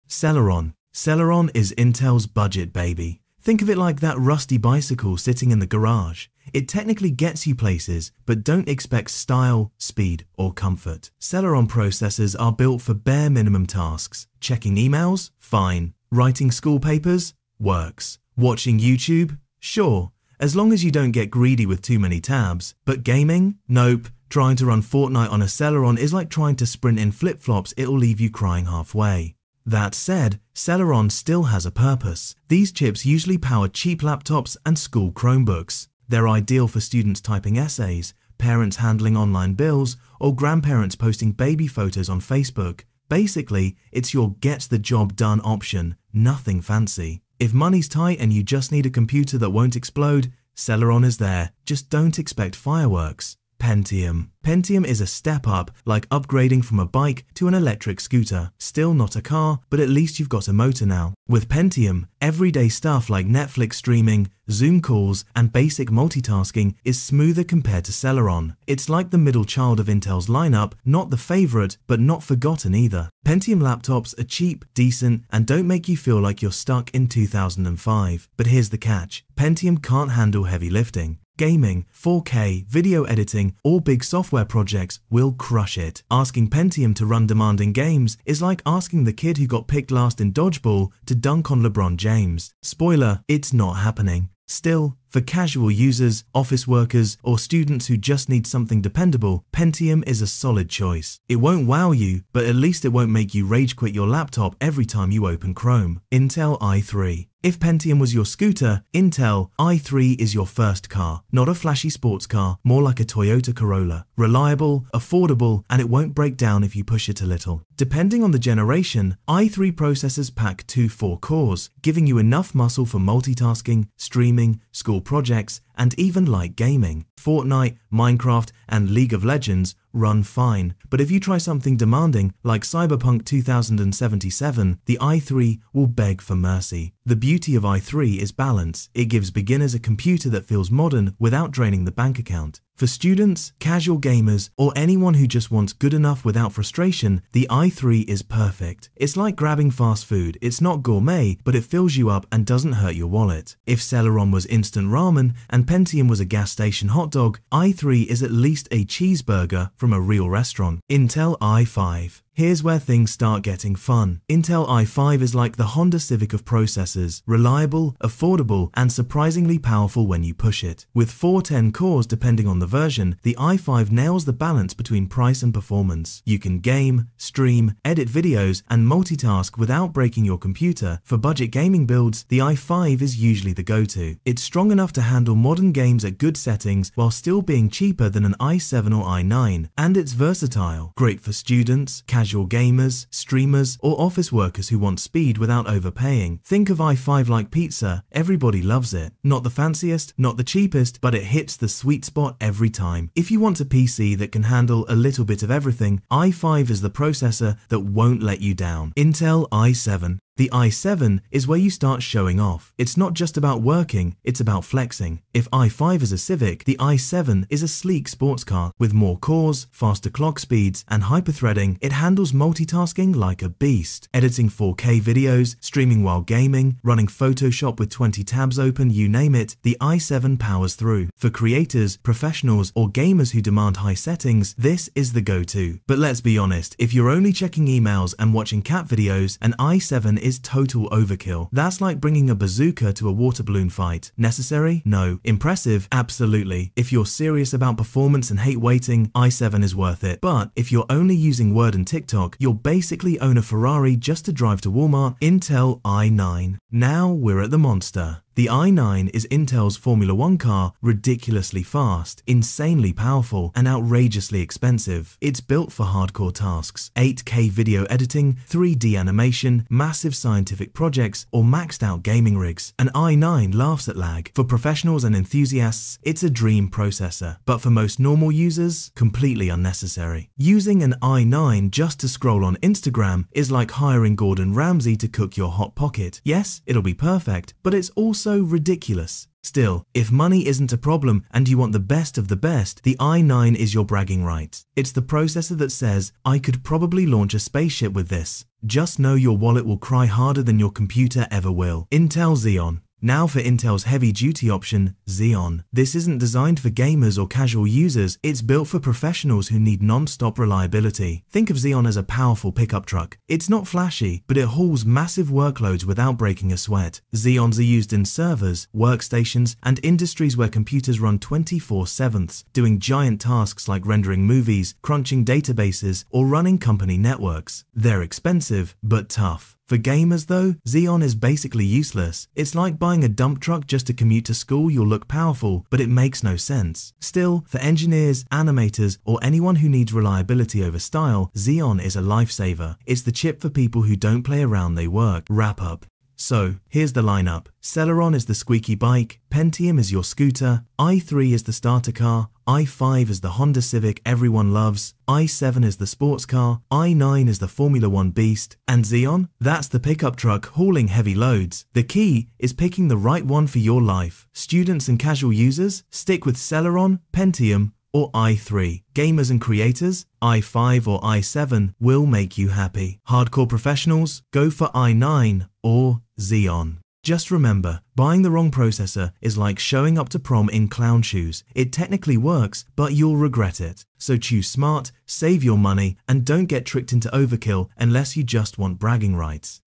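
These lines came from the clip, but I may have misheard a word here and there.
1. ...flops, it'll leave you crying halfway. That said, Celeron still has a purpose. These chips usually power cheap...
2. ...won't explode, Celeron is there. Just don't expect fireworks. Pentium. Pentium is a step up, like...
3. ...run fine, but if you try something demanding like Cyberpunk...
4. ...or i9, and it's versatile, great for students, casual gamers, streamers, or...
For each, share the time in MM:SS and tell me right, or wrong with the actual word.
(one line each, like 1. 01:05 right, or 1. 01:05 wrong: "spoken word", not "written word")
1. 00:27 right
2. 00:49 right
3. 02:09 right
4. 03:08 right.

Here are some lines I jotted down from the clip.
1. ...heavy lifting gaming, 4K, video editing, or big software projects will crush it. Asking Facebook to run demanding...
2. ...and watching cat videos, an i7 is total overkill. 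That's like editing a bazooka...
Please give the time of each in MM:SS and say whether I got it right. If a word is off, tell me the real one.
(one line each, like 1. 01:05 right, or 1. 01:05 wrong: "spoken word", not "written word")
1. 01:20 wrong: "Pentium", not "Facebook"
2. 03:58 wrong: "bringing", not "editing".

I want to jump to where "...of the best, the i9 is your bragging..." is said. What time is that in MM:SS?
04:52.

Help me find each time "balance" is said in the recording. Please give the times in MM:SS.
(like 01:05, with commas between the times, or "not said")
02:18, 02:54.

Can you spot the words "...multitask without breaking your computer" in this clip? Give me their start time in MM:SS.
02:58.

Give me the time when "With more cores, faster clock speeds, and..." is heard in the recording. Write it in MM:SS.
03:38.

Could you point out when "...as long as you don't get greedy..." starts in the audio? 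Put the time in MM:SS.
00:20.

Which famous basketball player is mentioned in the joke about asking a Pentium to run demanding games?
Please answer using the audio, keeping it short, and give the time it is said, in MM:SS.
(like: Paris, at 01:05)
LeBron James, at 01:31.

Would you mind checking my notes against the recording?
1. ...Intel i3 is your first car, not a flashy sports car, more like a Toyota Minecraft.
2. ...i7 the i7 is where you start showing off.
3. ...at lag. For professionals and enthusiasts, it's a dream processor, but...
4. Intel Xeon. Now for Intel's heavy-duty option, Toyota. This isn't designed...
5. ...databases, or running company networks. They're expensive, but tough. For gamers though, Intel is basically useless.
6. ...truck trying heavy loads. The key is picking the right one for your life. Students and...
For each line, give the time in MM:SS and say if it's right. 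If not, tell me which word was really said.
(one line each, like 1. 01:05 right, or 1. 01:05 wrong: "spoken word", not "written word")
1. 01:48 wrong: "Corolla", not "Minecraft"
2. 03:29 right
3. 04:33 right
4. 05:01 wrong: "Xeon", not "Toyota"
5. 05:25 wrong: "Xeon", not "Intel"
6. 06:00 wrong: "hauling", not "trying".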